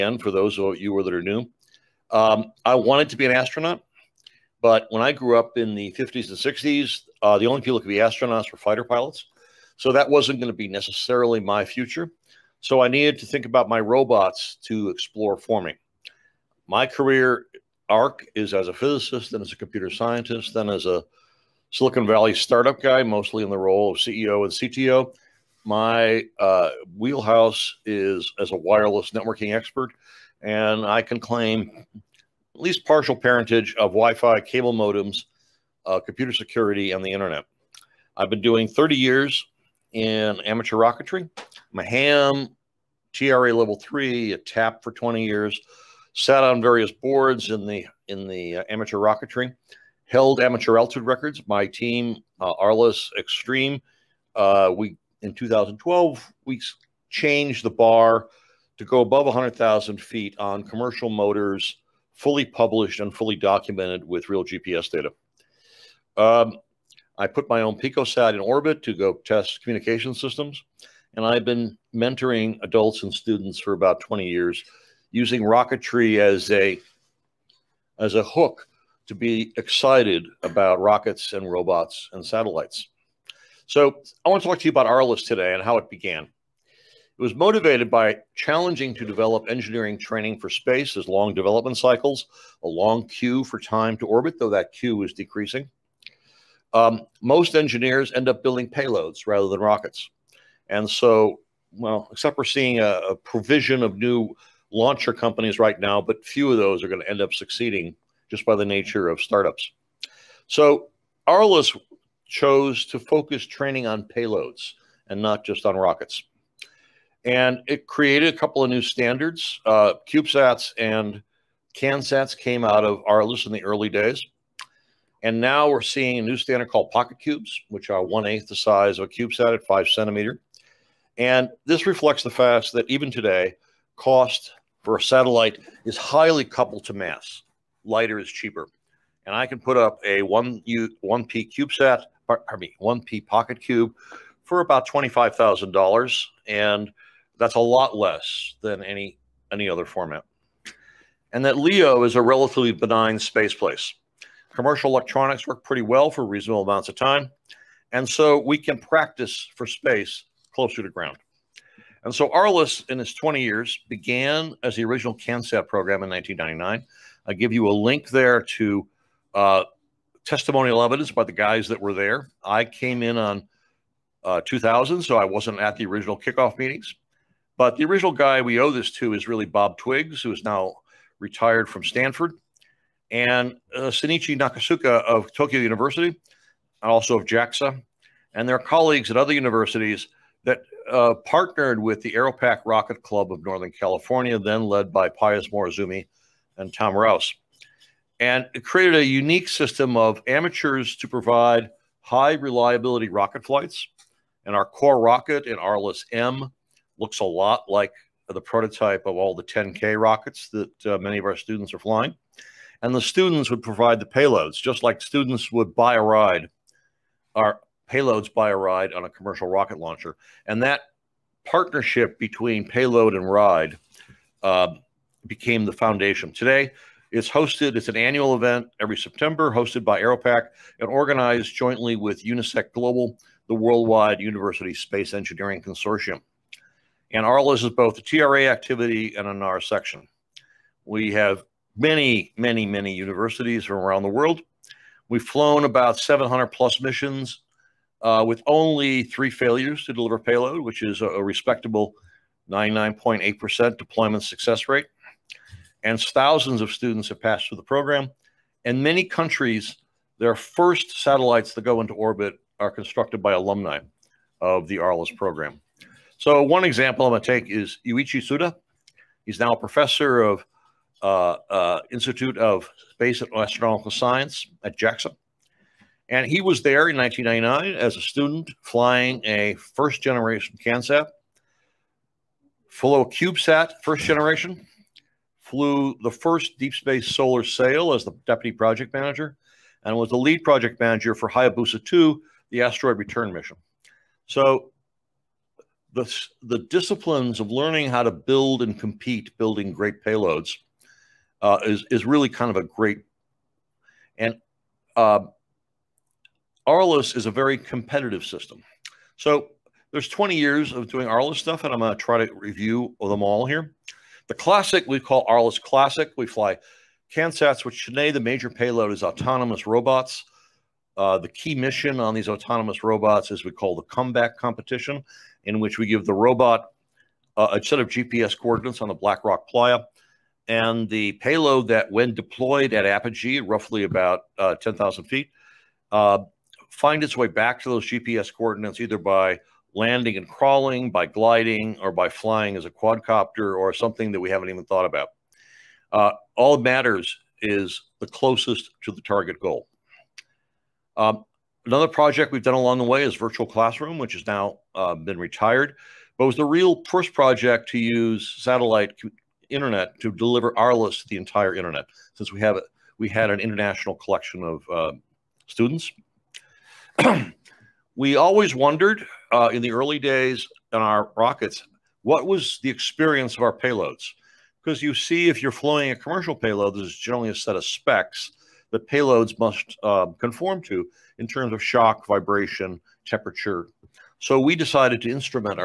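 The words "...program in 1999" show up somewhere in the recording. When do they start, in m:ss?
2:45.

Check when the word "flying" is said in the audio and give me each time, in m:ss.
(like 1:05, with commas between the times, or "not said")
3:31, 4:38, 5:42, 6:15.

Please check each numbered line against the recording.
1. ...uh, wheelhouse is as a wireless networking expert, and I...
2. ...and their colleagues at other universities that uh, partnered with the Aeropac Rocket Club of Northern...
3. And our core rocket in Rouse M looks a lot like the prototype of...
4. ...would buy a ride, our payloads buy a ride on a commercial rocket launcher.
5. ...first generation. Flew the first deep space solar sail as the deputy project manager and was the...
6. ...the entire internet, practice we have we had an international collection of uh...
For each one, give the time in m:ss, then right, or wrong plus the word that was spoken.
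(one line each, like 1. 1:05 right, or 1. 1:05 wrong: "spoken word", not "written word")
1. 0:26 right
2. 3:08 right
3. 3:24 wrong: "ARLISS", not "Rouse"
4. 3:35 right
5. 4:43 right
6. 6:01 wrong: "since", not "practice".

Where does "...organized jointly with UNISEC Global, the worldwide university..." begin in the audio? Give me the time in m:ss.
3:50.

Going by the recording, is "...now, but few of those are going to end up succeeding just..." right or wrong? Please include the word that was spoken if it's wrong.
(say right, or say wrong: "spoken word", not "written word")
right.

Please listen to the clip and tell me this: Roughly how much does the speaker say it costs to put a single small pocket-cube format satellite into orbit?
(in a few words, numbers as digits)
$25,000.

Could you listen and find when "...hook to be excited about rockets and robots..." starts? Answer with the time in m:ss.
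1:18.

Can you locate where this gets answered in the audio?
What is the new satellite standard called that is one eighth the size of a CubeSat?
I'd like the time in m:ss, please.
2:06.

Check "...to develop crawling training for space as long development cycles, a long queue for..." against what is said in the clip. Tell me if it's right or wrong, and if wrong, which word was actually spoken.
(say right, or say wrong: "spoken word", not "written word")
wrong: "engineering", not "crawling".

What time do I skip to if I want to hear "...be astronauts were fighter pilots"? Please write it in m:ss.
0:07.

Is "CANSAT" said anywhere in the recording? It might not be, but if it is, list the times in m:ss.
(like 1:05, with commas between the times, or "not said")
2:01, 2:45, 4:40, 5:17.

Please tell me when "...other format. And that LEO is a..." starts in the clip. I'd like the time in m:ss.
2:29.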